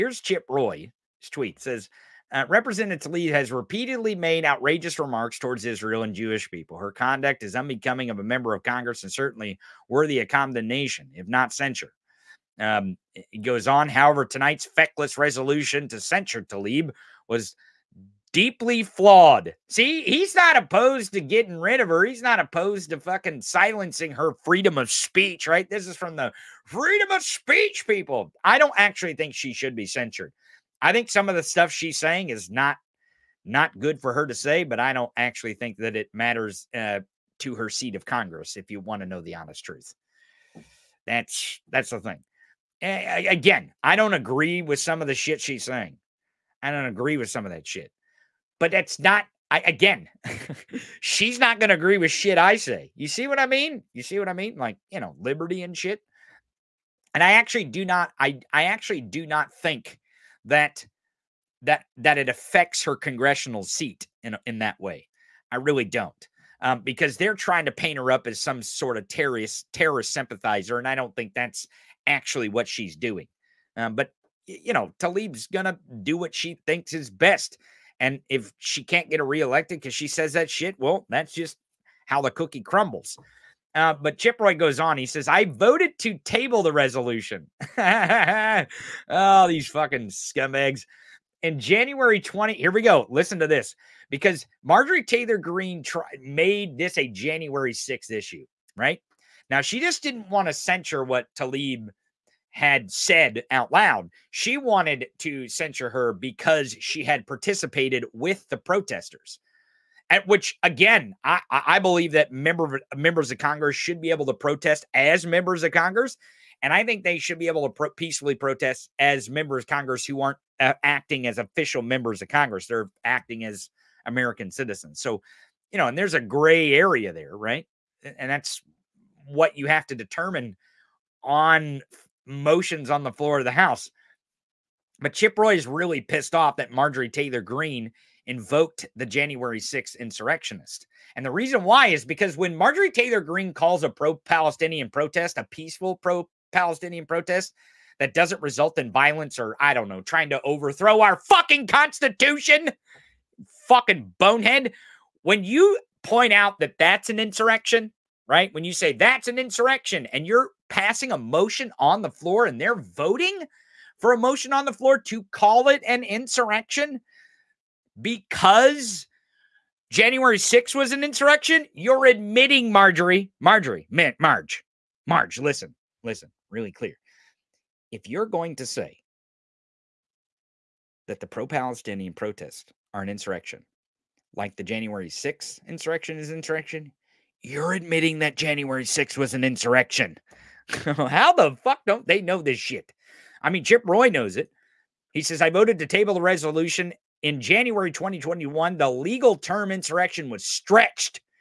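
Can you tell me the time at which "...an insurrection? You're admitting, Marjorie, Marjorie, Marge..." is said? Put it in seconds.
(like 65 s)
170 s.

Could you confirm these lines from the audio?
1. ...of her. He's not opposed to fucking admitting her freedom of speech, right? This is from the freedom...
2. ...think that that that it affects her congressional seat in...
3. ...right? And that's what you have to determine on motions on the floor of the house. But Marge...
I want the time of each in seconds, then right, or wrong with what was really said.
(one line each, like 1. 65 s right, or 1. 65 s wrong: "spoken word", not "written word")
1. 21 s wrong: "silencing", not "admitting"
2. 59 s right
3. 127 s wrong: "Chip", not "Marge".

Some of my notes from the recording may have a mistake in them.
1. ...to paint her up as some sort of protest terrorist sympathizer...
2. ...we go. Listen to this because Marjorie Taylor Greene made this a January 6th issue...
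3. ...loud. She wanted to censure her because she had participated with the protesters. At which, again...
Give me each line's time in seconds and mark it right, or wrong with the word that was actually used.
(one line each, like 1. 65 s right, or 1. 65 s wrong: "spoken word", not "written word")
1. 67 s wrong: "terrorist", not "protest"
2. 92 s right
3. 103 s right.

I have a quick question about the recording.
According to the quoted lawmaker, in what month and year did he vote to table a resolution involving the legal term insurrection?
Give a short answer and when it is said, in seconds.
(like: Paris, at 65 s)
January 2021, at 197 s.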